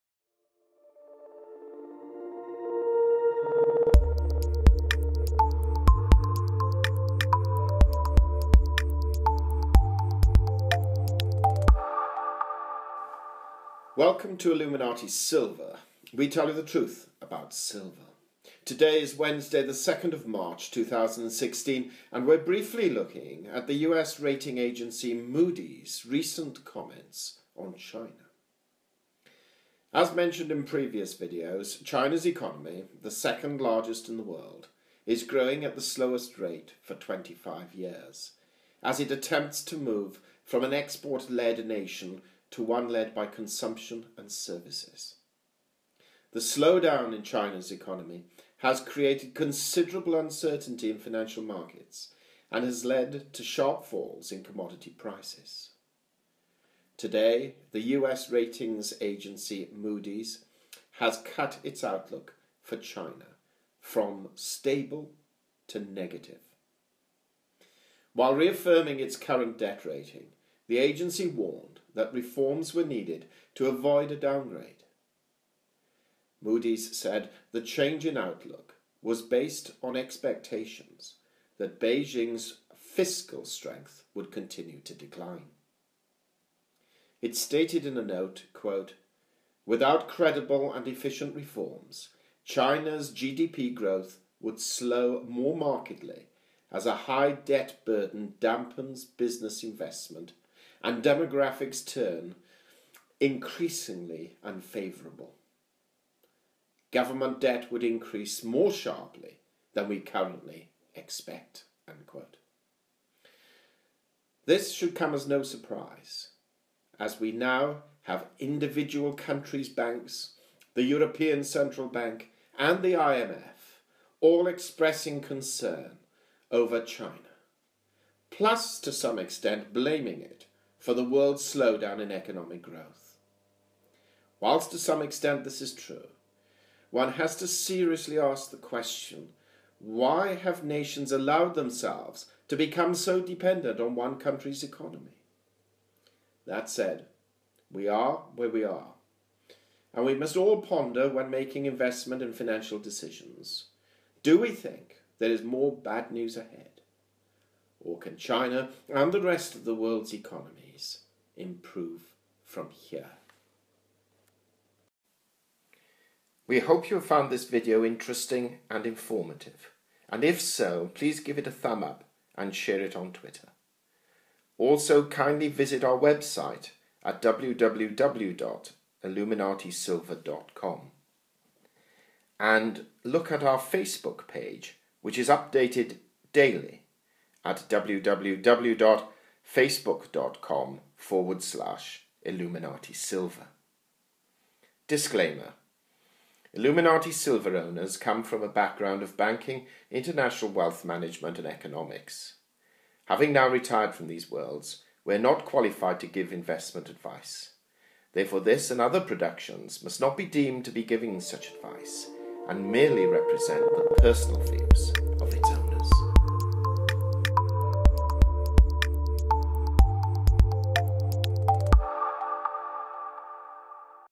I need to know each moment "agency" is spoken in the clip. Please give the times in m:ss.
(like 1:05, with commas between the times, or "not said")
0:24, 0:59, 1:10.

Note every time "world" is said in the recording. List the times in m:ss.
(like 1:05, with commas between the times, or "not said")
0:34, 2:11, 2:39, 3:24.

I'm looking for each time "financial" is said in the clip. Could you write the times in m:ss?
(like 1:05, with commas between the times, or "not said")
0:50, 2:32.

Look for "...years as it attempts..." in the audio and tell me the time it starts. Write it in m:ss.
0:37.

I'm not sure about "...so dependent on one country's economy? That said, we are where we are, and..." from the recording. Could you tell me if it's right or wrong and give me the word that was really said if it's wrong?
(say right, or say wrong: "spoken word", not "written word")
right.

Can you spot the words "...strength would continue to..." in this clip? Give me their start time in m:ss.
1:23.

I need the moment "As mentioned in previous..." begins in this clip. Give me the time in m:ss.
0:29.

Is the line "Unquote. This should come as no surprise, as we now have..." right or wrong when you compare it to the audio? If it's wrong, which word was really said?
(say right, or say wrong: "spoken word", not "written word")
right.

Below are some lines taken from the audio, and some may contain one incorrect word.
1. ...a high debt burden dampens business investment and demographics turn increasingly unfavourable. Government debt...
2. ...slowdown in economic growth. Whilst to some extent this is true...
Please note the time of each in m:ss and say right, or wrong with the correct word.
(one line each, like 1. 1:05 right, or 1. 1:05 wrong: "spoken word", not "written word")
1. 1:36 right
2. 2:11 right.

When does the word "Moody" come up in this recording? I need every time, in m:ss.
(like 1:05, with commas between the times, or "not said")
0:25, 0:59, 1:16.